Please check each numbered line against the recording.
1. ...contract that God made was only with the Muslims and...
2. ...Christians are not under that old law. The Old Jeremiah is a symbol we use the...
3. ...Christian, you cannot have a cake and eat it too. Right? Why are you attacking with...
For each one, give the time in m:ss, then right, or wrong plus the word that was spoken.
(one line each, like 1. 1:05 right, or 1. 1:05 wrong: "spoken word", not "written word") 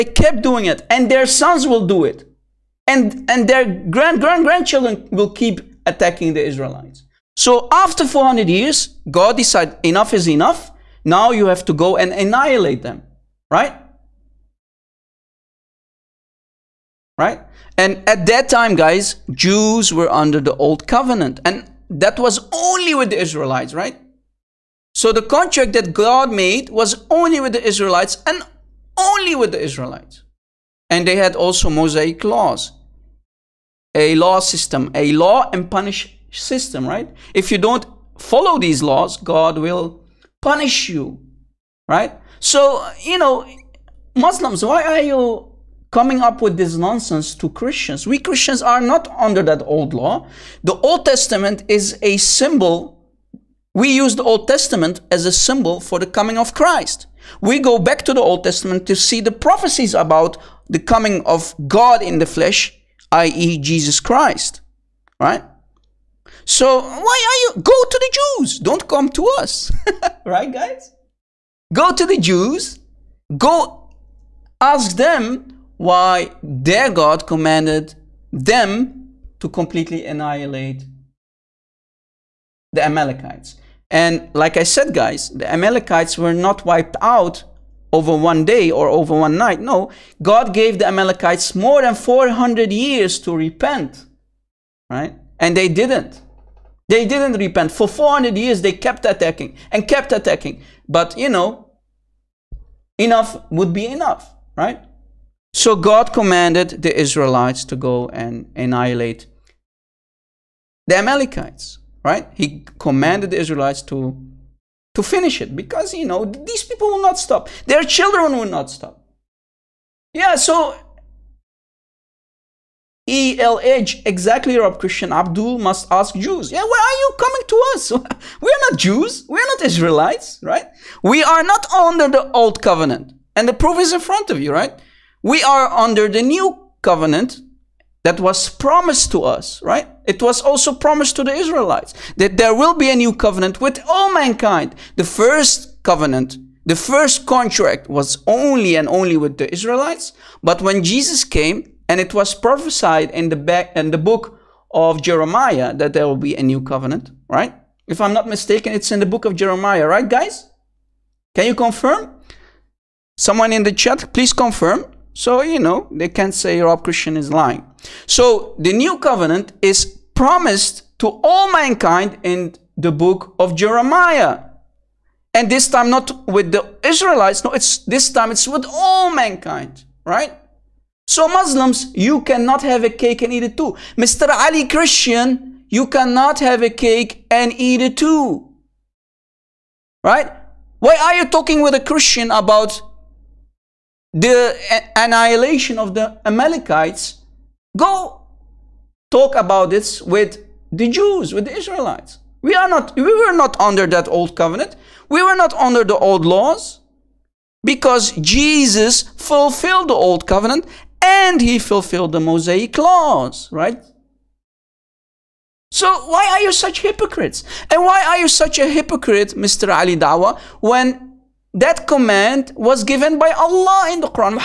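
1. 0:25 wrong: "Israelites", not "Muslims"
2. 0:48 wrong: "Testament", not "Jeremiah"
3. 3:04 wrong: "talking", not "attacking".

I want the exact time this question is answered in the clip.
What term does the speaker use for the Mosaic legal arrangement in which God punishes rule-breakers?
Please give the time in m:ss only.
0:35.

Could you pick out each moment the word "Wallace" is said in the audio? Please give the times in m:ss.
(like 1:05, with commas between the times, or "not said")
not said.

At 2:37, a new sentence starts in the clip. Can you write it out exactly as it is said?
If I'm not mistaken, it's in the book of Jeremiah, right, guys?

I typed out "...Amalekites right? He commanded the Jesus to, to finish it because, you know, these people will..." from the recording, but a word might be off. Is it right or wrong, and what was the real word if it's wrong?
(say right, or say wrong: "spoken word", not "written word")
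wrong: "Israelites", not "Jesus".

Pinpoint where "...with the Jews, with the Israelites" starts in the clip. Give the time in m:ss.
3:20.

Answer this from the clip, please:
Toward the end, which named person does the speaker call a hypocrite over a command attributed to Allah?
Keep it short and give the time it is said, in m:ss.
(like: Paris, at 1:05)
Ali Dawah, at 3:39.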